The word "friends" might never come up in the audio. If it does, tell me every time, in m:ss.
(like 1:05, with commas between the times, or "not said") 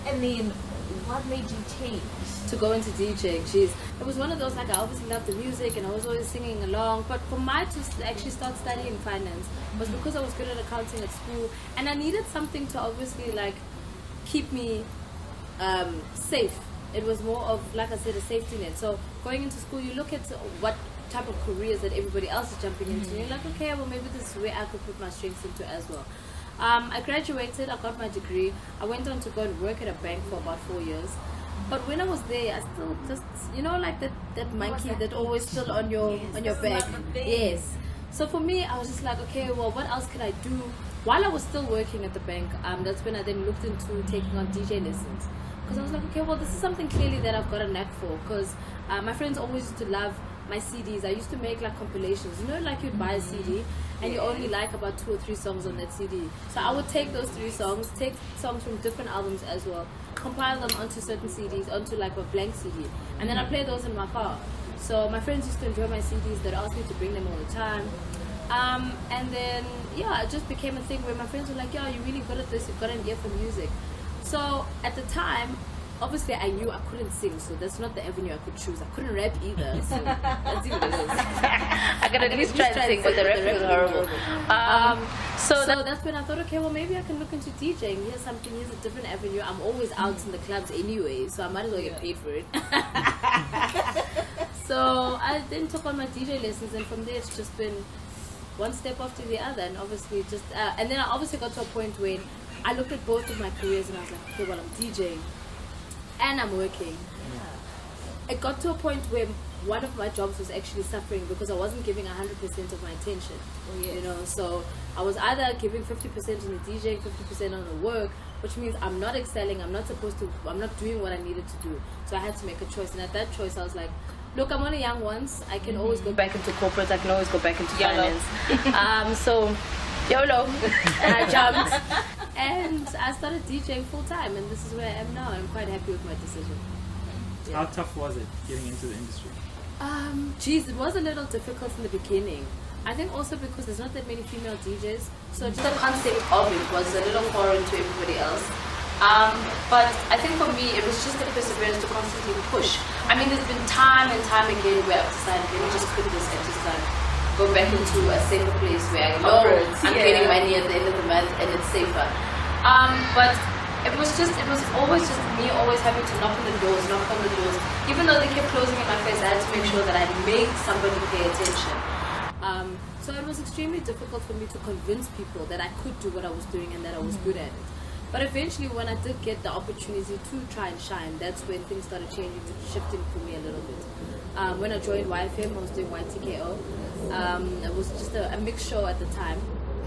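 0:49, 1:05, 1:11.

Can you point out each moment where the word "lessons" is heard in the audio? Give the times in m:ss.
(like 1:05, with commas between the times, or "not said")
0:44, 1:36.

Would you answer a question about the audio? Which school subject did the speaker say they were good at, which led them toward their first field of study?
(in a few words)
Accounting.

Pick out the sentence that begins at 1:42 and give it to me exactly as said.
I looked at both of my careers and I was like, okay, well, I'm DJing and I'm working.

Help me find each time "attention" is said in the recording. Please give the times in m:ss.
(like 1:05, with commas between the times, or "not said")
1:52, 2:51.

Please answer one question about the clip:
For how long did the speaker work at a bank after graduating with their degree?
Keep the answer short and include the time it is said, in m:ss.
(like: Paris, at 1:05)
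4 years, at 0:30.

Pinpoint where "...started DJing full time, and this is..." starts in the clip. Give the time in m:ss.
2:13.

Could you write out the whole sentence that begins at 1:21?
I could at least try to sing, but the rap was horrible.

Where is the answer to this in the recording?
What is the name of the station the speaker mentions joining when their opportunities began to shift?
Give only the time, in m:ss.
3:05.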